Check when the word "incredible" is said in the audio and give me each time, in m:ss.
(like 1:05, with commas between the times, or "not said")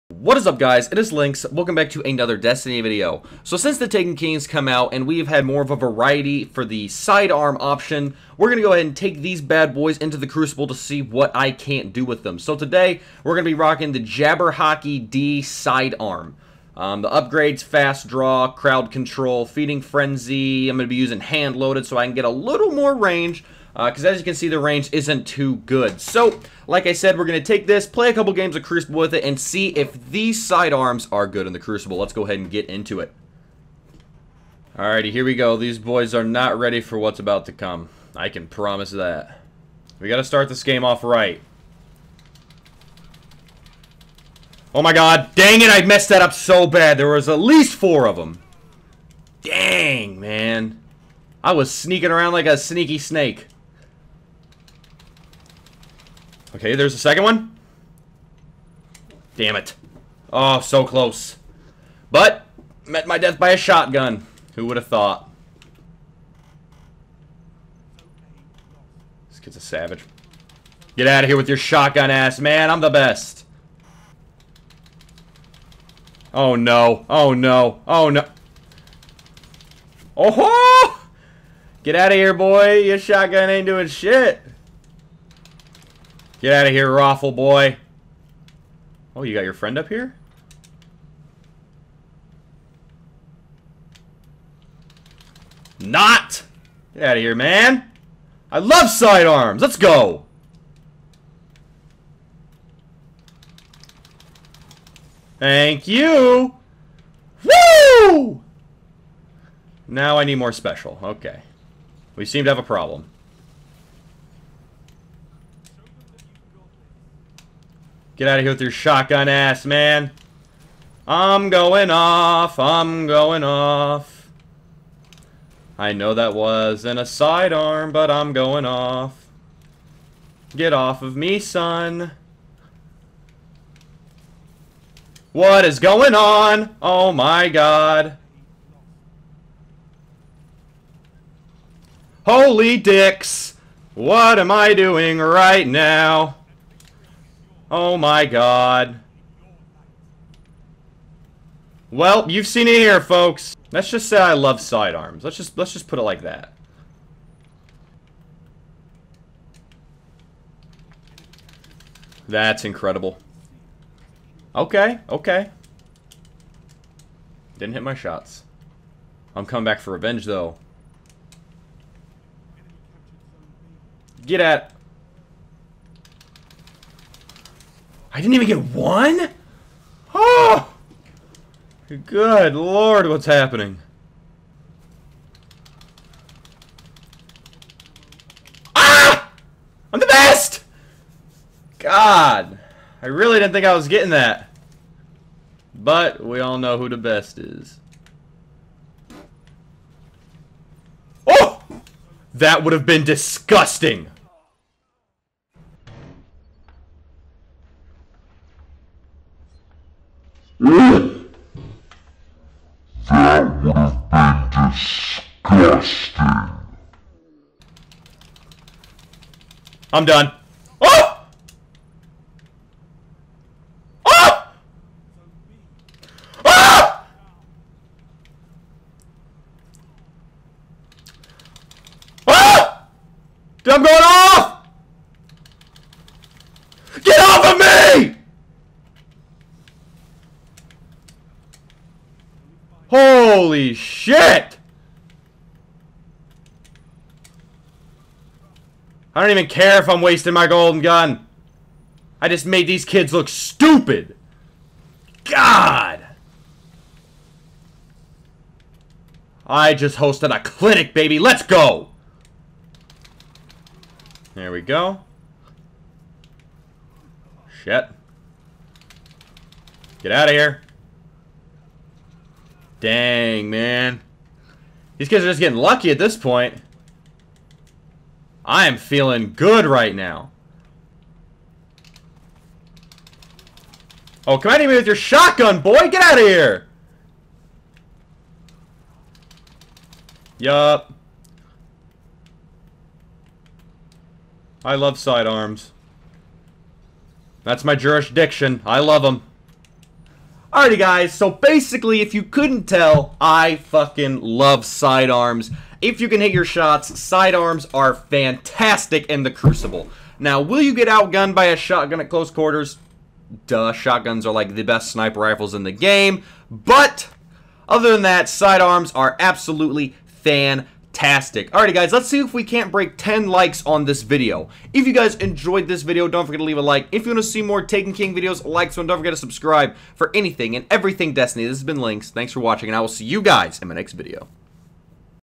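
2:42.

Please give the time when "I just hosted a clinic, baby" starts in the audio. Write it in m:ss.
4:19.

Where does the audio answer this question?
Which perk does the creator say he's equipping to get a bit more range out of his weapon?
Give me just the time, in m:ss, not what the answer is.
0:21.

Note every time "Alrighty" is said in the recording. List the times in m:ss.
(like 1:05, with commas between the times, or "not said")
0:34, 5:00, 5:21.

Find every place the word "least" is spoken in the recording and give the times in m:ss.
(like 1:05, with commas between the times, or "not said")
0:47.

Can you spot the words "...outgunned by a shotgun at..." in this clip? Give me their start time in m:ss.
5:10.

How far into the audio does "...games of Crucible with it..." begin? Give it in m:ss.
0:28.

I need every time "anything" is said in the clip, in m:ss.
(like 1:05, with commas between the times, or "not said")
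5:30.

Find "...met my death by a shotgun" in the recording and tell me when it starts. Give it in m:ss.
1:02.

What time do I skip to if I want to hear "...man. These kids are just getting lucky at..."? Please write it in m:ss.
4:33.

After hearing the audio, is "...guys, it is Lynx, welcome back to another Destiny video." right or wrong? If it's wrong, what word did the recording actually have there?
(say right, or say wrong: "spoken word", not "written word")
right.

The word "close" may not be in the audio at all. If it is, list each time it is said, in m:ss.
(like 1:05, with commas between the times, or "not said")
1:00, 5:12.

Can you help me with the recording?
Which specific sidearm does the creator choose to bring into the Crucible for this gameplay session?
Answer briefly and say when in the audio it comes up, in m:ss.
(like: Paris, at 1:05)
Jabberwocky-D, at 0:13.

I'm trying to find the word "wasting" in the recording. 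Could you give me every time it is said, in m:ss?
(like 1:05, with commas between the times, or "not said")
4:10.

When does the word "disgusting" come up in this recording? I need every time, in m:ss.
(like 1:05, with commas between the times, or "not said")
3:23, 3:34.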